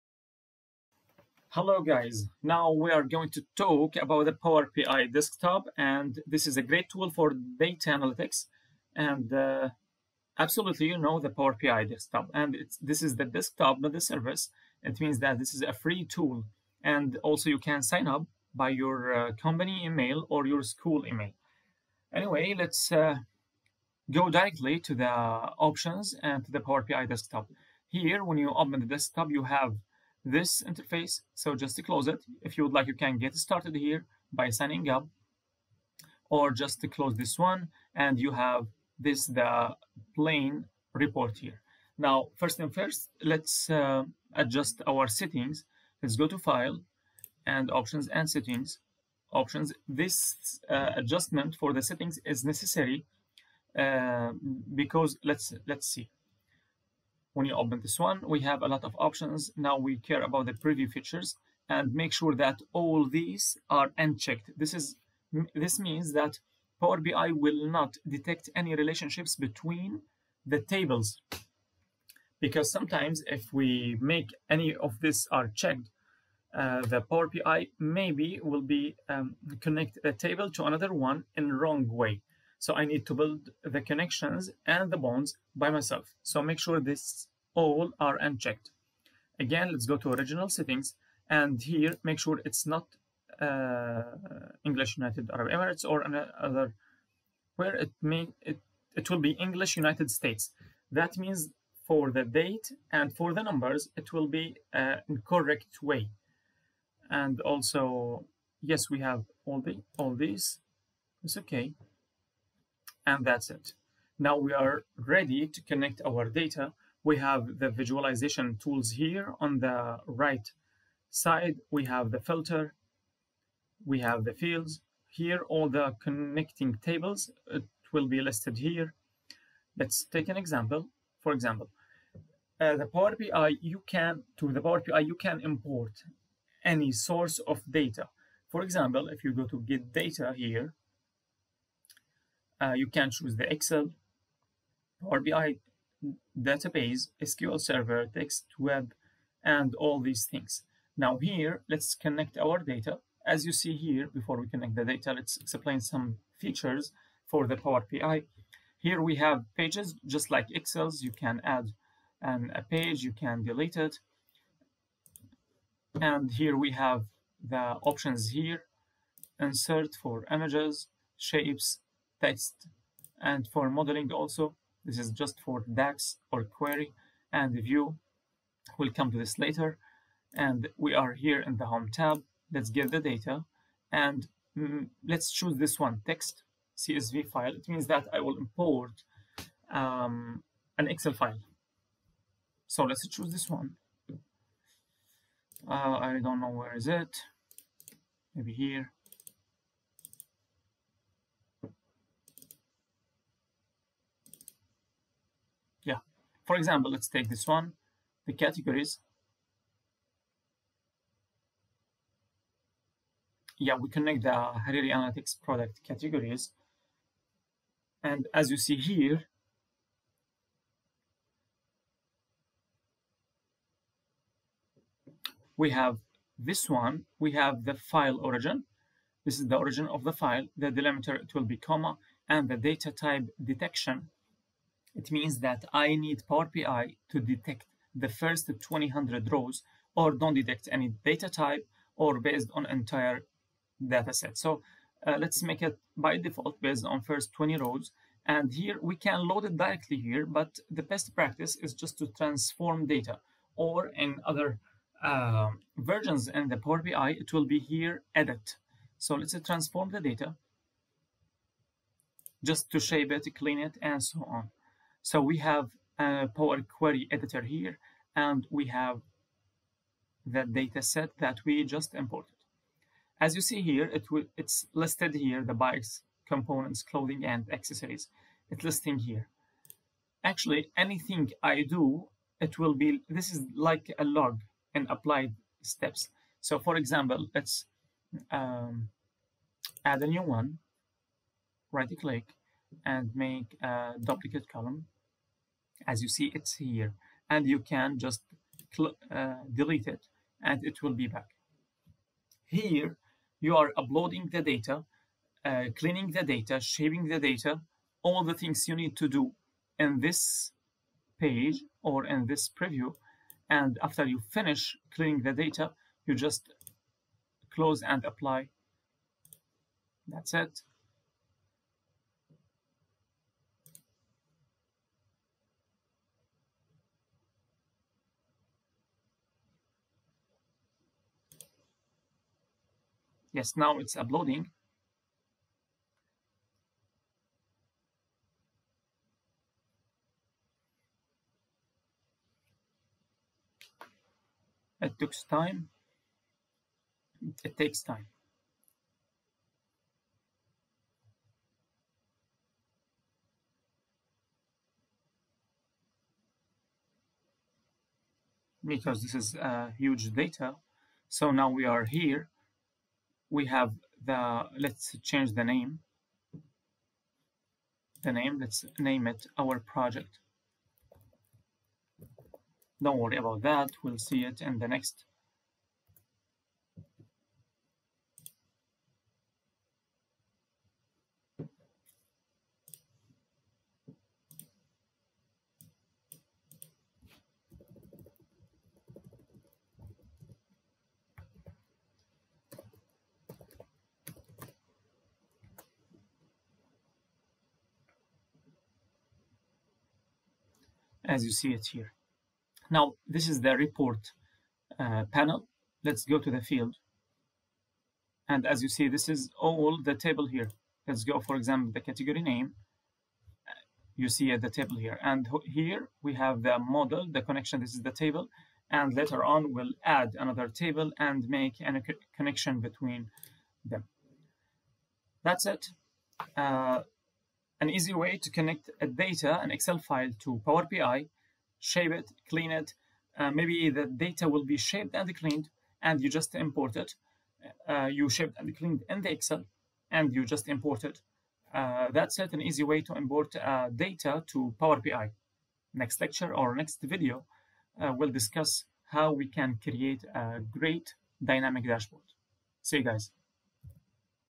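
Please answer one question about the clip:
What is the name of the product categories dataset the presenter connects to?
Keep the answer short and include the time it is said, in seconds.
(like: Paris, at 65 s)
Hariri Analytics, at 214 s.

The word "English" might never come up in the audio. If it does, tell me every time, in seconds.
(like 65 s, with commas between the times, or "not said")
94 s, 99 s.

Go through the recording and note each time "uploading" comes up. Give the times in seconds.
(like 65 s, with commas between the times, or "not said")
303 s, 333 s.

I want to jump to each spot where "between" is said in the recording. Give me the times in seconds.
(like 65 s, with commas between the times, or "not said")
69 s, 422 s.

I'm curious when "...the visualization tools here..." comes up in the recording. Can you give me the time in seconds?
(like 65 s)
117 s.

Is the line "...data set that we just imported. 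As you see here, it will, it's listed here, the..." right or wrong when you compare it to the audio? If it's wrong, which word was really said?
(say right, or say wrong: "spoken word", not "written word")
right.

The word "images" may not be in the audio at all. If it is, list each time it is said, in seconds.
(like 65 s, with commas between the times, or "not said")
170 s.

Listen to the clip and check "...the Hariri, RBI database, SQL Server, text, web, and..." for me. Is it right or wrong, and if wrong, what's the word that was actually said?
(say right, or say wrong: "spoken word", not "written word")
wrong: "Excel", not "Hariri".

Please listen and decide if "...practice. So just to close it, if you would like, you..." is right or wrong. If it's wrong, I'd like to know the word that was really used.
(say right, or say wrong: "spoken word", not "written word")
wrong: "interface", not "practice".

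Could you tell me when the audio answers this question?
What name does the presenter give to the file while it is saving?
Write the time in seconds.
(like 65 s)
369 s.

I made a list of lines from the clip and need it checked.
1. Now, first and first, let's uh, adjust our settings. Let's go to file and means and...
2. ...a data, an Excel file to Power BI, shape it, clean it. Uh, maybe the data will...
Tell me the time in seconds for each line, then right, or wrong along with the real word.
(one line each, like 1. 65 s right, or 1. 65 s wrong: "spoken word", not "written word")
1. 41 s wrong: "options", not "means"
2. 428 s right.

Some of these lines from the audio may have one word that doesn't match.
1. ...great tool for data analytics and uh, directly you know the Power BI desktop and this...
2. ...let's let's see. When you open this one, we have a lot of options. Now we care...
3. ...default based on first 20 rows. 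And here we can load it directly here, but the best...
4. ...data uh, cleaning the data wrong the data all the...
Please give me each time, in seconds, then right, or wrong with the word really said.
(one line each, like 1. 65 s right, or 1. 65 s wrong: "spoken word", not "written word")
1. 6 s wrong: "absolutely", not "directly"
2. 55 s right
3. 246 s right
4. 304 s wrong: "shaving", not "wrong".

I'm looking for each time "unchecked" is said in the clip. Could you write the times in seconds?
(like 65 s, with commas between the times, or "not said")
63 s, 88 s.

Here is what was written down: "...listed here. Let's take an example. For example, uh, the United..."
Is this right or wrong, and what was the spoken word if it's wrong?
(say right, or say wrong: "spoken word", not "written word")
wrong: "Power", not "United".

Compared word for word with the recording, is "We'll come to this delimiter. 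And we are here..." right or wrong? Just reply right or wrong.
wrong.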